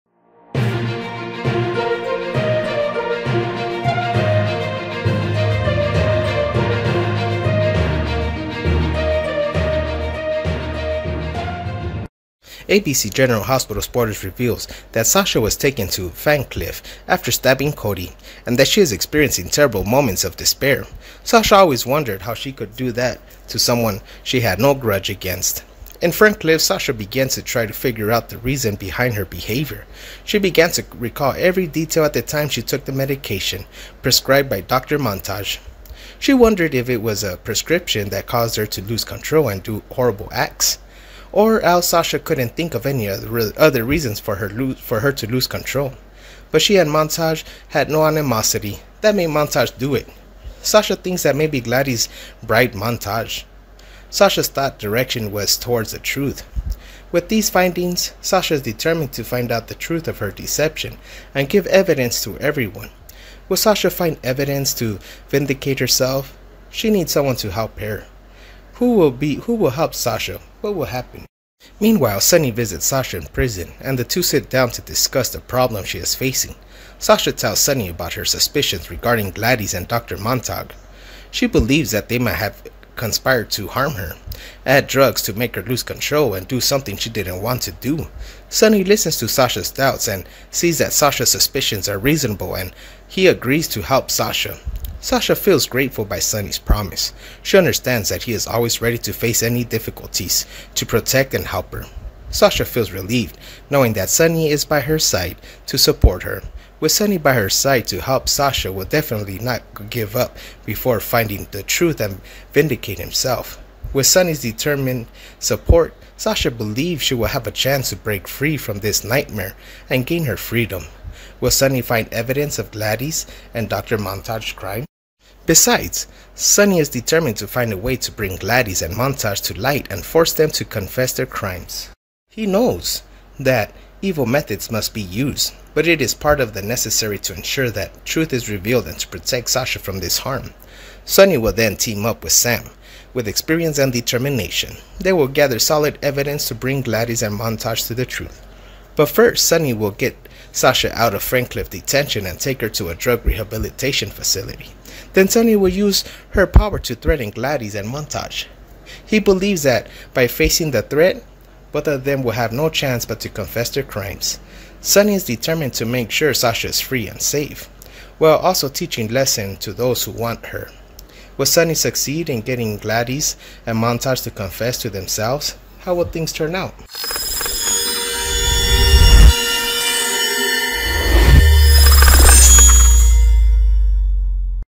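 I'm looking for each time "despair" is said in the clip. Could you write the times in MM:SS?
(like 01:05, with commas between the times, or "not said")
00:20.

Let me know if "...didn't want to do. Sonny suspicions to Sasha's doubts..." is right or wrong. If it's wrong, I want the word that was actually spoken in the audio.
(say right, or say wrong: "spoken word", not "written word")
wrong: "listens", not "suspicions".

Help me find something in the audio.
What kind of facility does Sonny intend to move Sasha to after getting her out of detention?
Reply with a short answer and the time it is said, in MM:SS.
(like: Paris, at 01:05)
drug rehabilitation facility, at 02:32.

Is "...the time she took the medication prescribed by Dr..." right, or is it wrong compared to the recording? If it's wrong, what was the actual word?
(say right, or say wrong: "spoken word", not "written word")
right.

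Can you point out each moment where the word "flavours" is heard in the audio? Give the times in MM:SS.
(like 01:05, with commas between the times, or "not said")
not said.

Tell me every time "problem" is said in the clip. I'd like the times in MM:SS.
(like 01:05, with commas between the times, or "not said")
01:15.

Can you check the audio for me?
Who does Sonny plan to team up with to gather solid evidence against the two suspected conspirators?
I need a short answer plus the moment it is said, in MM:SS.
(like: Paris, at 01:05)
Sam, at 02:22.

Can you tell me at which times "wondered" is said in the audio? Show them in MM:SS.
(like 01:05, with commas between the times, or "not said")
00:21, 00:36.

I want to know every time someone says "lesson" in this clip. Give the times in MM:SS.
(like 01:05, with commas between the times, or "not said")
02:49.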